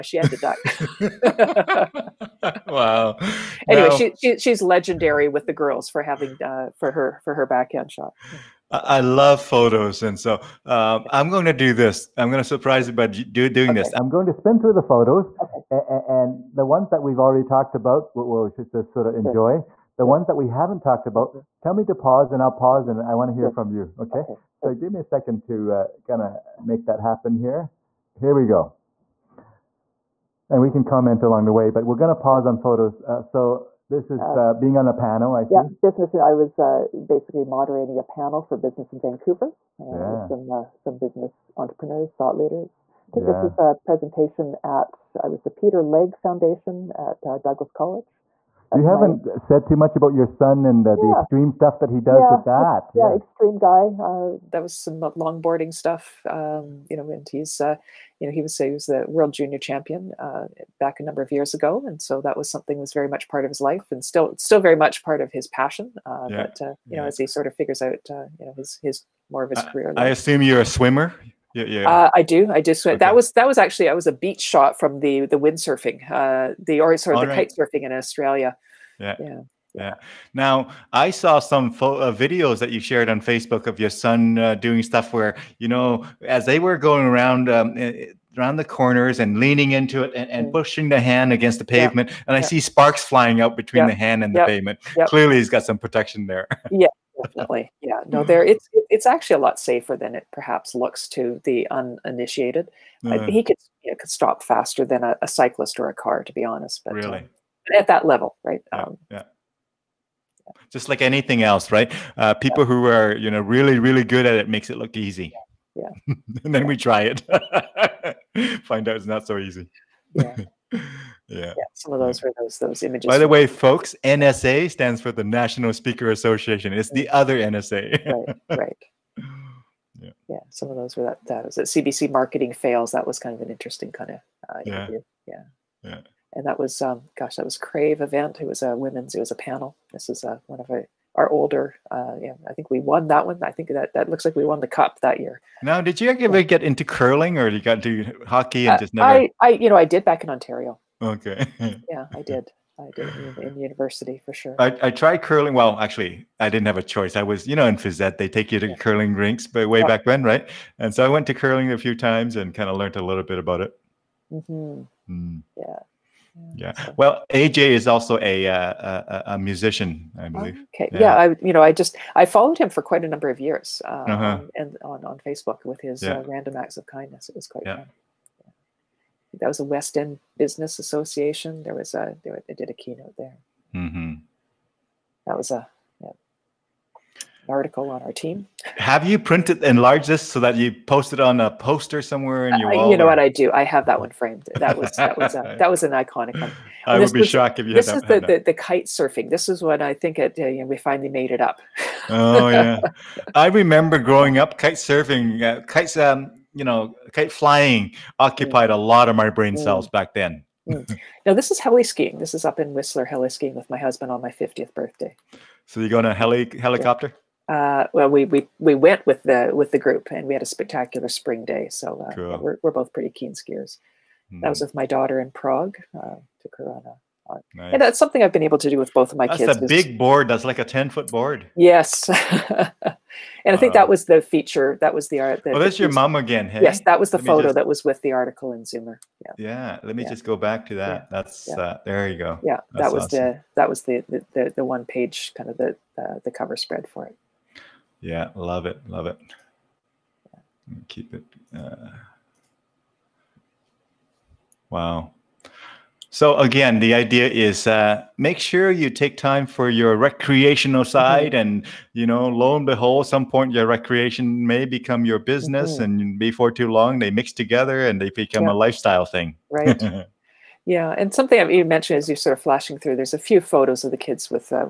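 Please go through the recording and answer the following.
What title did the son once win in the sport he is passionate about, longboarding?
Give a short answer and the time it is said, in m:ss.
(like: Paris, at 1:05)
World junior champion, at 0:59.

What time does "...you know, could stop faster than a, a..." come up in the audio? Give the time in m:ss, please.
1:43.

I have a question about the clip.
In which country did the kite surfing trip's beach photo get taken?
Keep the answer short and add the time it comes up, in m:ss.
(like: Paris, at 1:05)
Australia, at 1:17.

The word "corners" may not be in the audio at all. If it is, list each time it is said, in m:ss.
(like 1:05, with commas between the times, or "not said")
1:28.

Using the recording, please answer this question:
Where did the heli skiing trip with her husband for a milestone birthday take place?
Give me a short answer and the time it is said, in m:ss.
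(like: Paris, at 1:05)
Whistler, at 3:32.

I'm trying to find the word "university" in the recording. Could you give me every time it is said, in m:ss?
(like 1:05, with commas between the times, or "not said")
2:33.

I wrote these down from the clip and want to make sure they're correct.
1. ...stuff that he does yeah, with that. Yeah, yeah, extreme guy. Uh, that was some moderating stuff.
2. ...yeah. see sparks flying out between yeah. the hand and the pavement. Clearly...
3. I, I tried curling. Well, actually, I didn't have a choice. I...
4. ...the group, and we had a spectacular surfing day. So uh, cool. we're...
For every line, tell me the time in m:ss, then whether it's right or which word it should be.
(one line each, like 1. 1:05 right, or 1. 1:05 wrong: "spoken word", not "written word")
1. 0:51 wrong: "longboarding", not "moderating"
2. 1:32 right
3. 2:34 right
4. 3:39 wrong: "spring", not "surfing".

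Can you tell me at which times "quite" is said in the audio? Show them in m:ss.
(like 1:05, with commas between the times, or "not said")
2:52, 2:57.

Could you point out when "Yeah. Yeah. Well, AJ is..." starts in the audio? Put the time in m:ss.
2:45.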